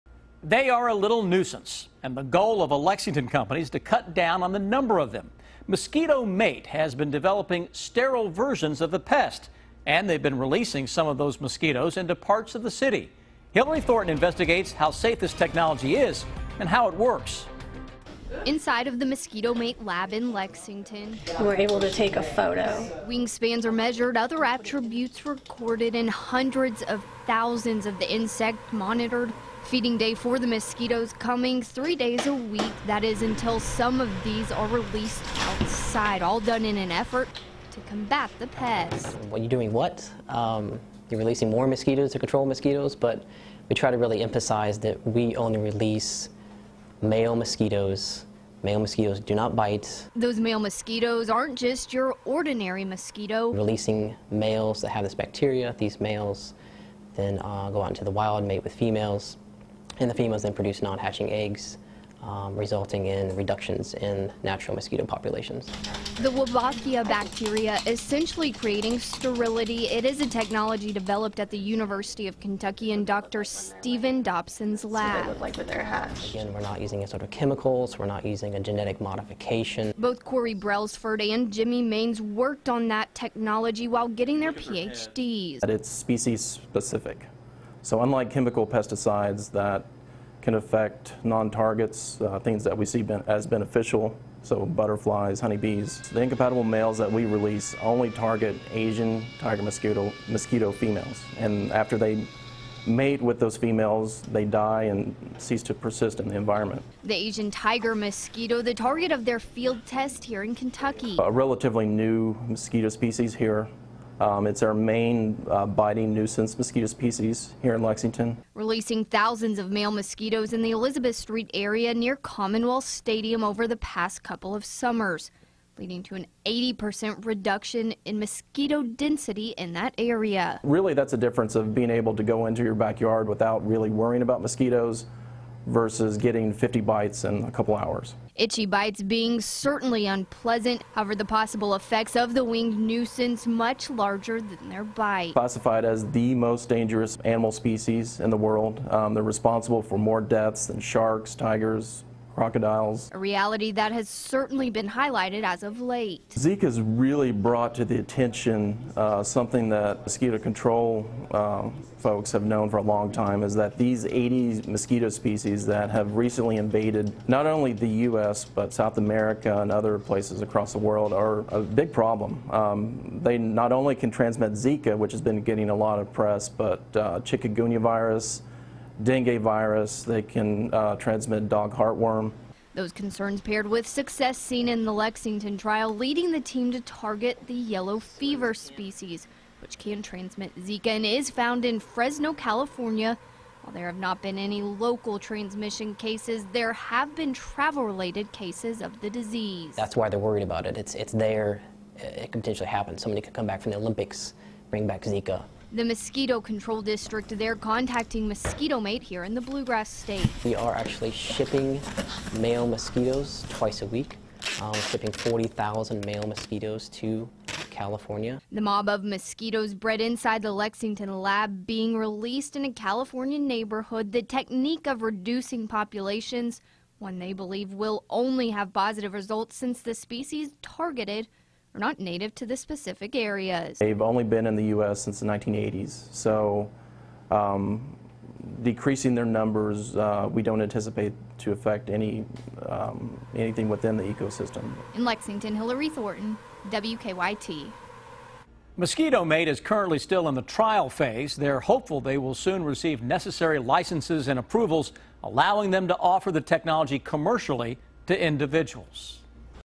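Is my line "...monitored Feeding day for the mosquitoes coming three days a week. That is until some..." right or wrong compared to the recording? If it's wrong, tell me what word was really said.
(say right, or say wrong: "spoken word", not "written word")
right.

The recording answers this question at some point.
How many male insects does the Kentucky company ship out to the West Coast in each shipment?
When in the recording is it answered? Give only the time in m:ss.
3:35.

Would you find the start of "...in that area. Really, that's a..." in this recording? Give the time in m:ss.
2:09.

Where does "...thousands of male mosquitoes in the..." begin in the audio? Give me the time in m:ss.
1:59.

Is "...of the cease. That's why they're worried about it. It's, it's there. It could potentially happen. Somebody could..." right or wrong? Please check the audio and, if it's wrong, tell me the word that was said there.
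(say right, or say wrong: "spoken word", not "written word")
wrong: "disease", not "cease".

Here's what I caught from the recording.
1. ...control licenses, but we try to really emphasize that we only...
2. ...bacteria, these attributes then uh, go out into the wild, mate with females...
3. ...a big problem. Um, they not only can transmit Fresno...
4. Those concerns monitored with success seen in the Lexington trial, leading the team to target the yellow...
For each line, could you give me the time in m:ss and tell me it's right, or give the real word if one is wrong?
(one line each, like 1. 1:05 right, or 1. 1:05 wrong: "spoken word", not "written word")
1. 0:42 wrong: "mosquitoes", not "licenses"
2. 0:55 wrong: "males", not "attributes"
3. 2:51 wrong: "Zika", not "Fresno"
4. 3:02 wrong: "paired", not "monitored".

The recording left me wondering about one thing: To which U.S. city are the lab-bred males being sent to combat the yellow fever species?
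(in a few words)
Fresno, California.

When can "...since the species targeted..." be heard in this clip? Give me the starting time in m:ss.
3:49.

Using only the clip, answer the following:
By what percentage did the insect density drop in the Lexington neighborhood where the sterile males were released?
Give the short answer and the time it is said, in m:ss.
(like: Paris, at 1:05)
80%, at 2:06.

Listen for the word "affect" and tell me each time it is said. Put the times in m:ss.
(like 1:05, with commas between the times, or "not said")
1:30, 4:01.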